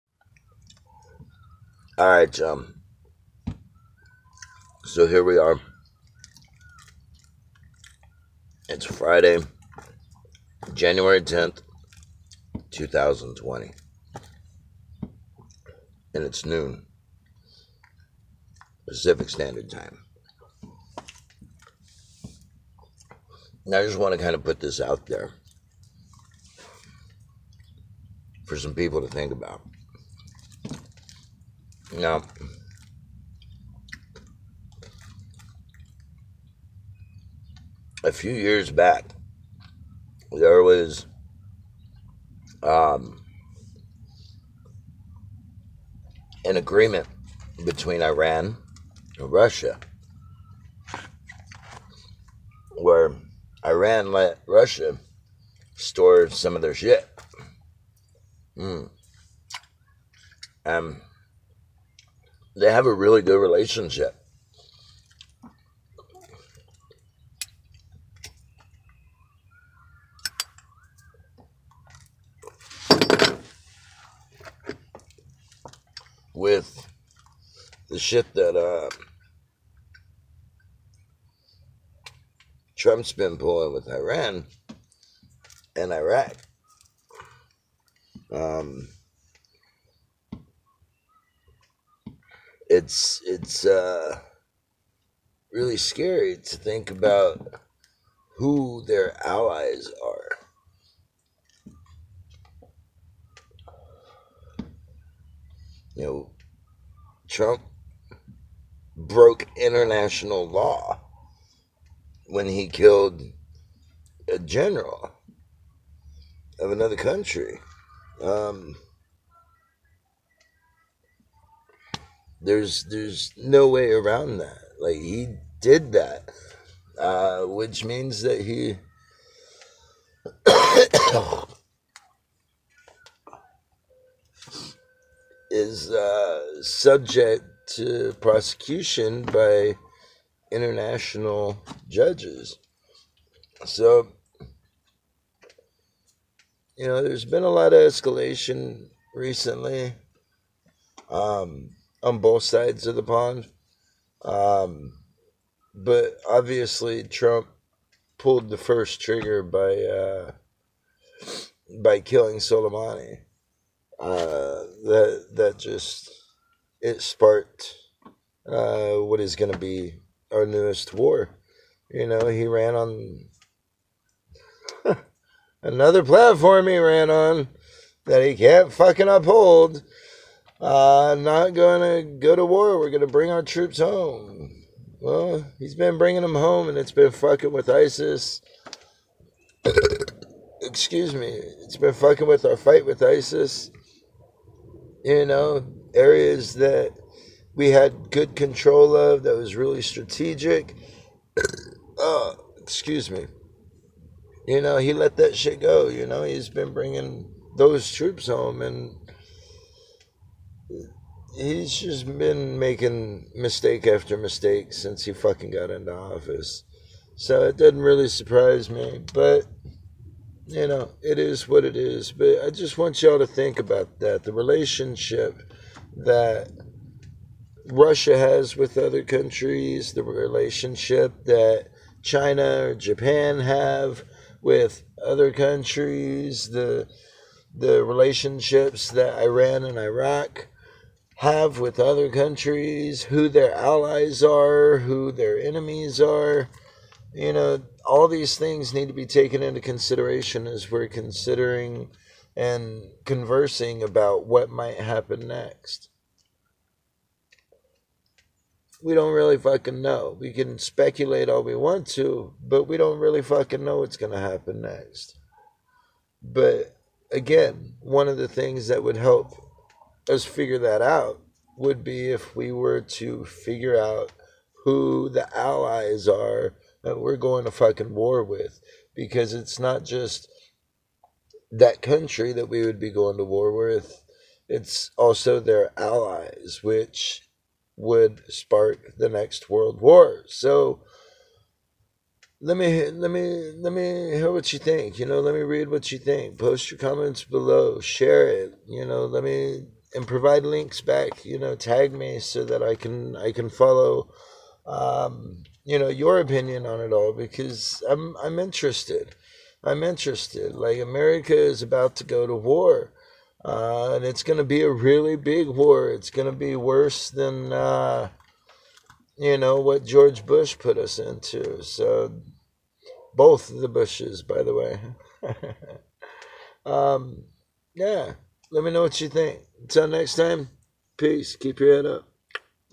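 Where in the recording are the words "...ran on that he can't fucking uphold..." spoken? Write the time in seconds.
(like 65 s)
176 s.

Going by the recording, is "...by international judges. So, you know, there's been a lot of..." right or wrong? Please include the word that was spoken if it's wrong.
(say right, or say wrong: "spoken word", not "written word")
right.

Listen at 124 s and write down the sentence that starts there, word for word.
Like he did that, uh, which means that he.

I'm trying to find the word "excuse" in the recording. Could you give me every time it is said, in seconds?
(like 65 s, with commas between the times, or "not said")
190 s, 202 s.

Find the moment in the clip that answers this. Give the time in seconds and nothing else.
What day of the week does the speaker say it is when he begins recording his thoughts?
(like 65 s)
8 s.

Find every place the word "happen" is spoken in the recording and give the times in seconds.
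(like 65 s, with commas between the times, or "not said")
254 s, 264 s.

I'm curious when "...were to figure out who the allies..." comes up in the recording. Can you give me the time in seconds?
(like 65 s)
272 s.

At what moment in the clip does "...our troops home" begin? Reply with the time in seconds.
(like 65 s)
183 s.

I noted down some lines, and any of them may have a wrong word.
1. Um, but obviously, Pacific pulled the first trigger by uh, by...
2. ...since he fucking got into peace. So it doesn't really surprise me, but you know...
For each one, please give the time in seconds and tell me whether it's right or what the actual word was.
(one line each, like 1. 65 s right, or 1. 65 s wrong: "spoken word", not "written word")
1. 154 s wrong: "Trump", not "Pacific"
2. 214 s wrong: "office", not "peace".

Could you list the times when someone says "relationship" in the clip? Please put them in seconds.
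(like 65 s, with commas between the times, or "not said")
63 s, 224 s, 230 s, 237 s.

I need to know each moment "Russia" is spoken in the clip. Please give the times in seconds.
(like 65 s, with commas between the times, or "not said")
49 s, 54 s, 227 s.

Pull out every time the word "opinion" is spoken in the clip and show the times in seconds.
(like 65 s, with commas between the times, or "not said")
306 s.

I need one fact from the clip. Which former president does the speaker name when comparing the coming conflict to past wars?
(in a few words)
George Bush.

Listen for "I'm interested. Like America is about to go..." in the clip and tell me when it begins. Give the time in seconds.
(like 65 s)
309 s.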